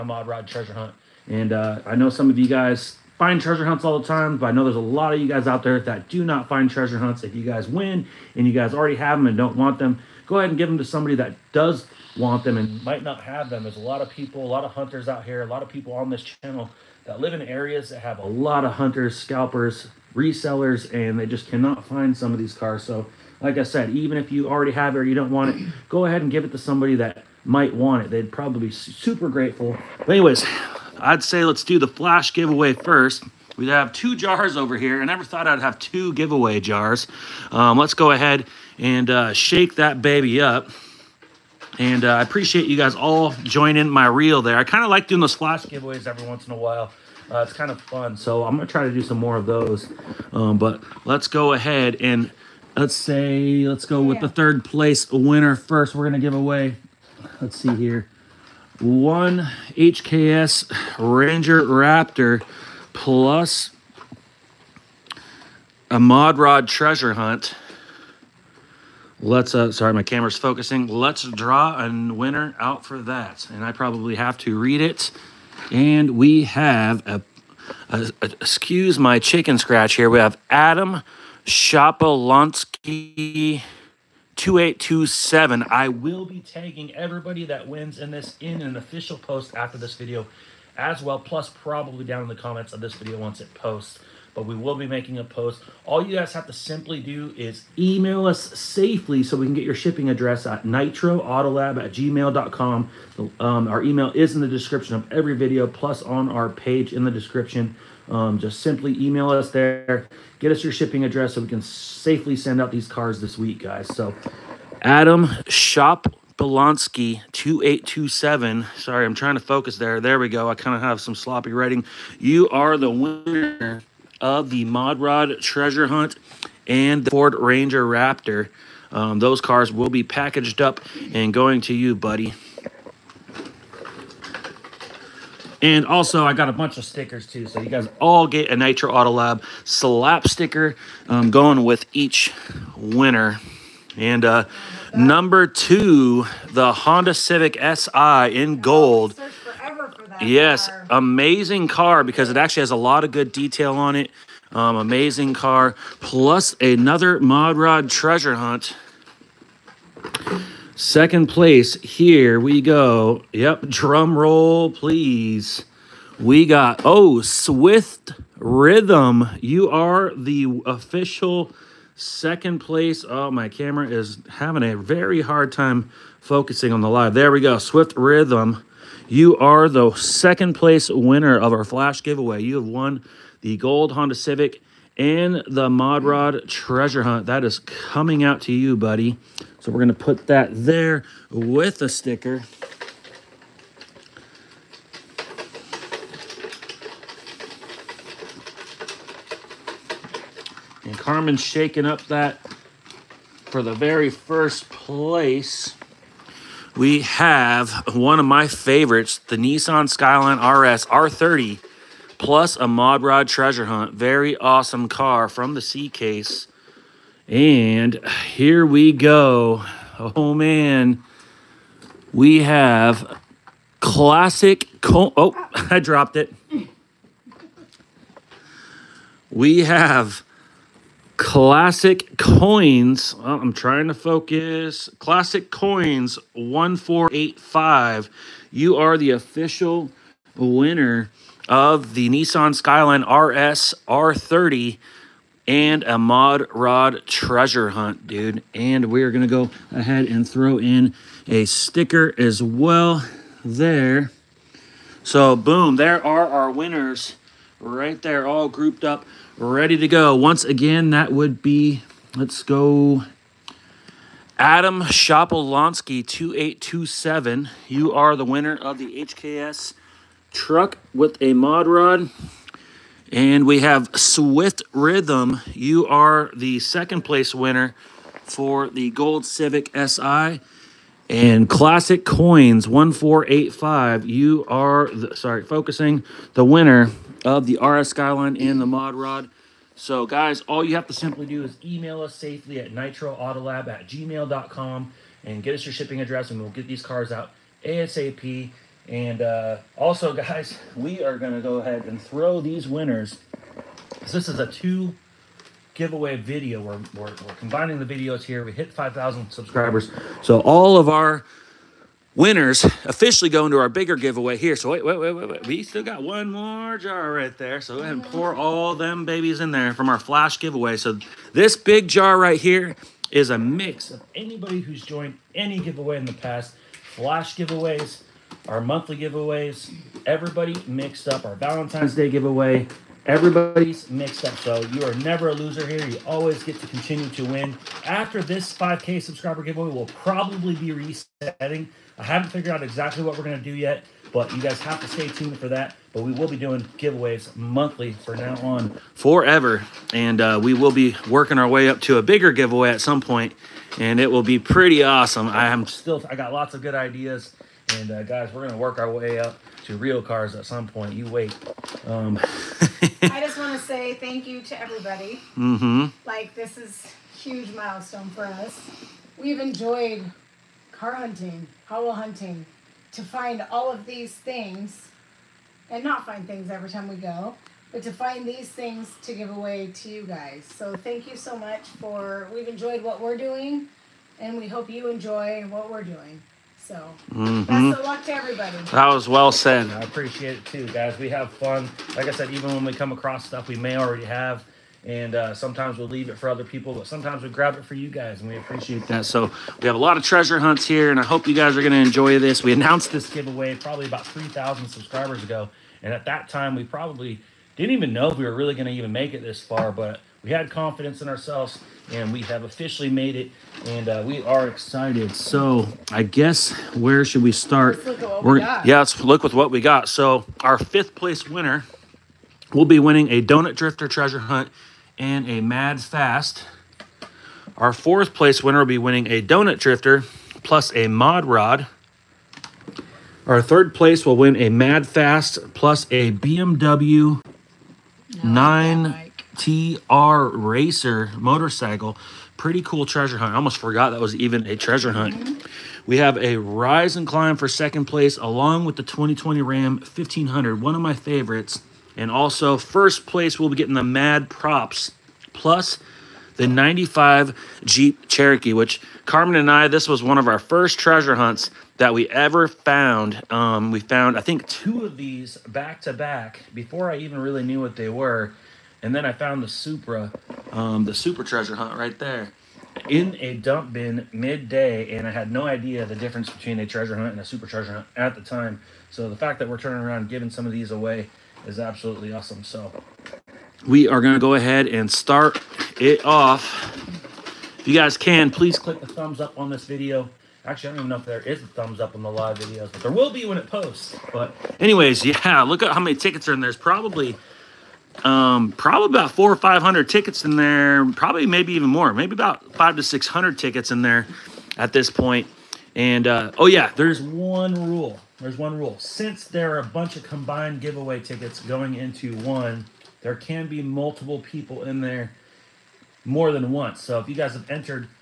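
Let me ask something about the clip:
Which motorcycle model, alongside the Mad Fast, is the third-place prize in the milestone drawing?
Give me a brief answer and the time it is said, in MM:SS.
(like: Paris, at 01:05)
9 TR Racer, at 07:18.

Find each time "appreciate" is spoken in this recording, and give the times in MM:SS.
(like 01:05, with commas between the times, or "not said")
00:42, 06:29, 06:38.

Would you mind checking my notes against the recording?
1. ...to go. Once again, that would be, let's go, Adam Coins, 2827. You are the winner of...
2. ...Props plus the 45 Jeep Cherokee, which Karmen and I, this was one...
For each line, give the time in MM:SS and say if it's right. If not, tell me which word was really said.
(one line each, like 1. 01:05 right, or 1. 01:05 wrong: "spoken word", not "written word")
1. 04:19 wrong: "Shopolonsky", not "Coins"
2. 07:34 wrong: "95", not "45".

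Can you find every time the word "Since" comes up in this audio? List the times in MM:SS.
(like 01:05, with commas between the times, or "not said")
08:28.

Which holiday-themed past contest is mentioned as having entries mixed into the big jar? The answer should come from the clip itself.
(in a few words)
Valentine's Day.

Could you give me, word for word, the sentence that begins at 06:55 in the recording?
So I guess where should we start?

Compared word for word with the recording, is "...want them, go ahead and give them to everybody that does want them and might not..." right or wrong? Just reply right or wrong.
wrong.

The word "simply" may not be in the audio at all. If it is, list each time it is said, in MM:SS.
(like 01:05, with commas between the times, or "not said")
01:36, 01:48, 04:50.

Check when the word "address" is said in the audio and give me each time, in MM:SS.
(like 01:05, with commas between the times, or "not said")
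01:40, 01:51, 04:56.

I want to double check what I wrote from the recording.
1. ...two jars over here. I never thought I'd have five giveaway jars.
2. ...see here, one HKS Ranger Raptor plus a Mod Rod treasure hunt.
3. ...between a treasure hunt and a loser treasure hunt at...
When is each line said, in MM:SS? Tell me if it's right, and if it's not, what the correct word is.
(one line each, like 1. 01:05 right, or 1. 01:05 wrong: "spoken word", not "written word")
1. 00:33 wrong: "two", not "five"
2. 00:57 right
3. 07:56 wrong: "super", not "loser".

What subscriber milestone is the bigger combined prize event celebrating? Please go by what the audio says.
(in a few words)
5,000.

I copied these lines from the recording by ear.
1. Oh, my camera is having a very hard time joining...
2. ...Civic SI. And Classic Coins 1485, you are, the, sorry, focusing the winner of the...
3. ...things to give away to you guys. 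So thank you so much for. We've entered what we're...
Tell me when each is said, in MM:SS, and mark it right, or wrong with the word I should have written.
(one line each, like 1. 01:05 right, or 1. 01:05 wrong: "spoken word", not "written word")
1. 02:53 wrong: "focusing", not "joining"
2. 04:39 right
3. 06:18 wrong: "enjoyed", not "entered".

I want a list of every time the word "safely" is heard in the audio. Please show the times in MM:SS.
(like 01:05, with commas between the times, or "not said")
01:38, 01:51, 04:52.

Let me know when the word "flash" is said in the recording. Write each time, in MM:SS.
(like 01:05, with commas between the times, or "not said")
00:31, 00:45, 03:01, 05:19, 05:26.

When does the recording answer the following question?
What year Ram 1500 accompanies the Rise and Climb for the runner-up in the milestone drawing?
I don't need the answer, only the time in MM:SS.
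07:28.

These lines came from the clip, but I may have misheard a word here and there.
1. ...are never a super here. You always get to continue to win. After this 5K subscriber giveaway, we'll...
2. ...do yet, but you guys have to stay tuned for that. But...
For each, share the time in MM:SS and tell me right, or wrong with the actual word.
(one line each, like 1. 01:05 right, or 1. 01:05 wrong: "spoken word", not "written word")
1. 05:34 wrong: "loser", not "super"
2. 05:43 right.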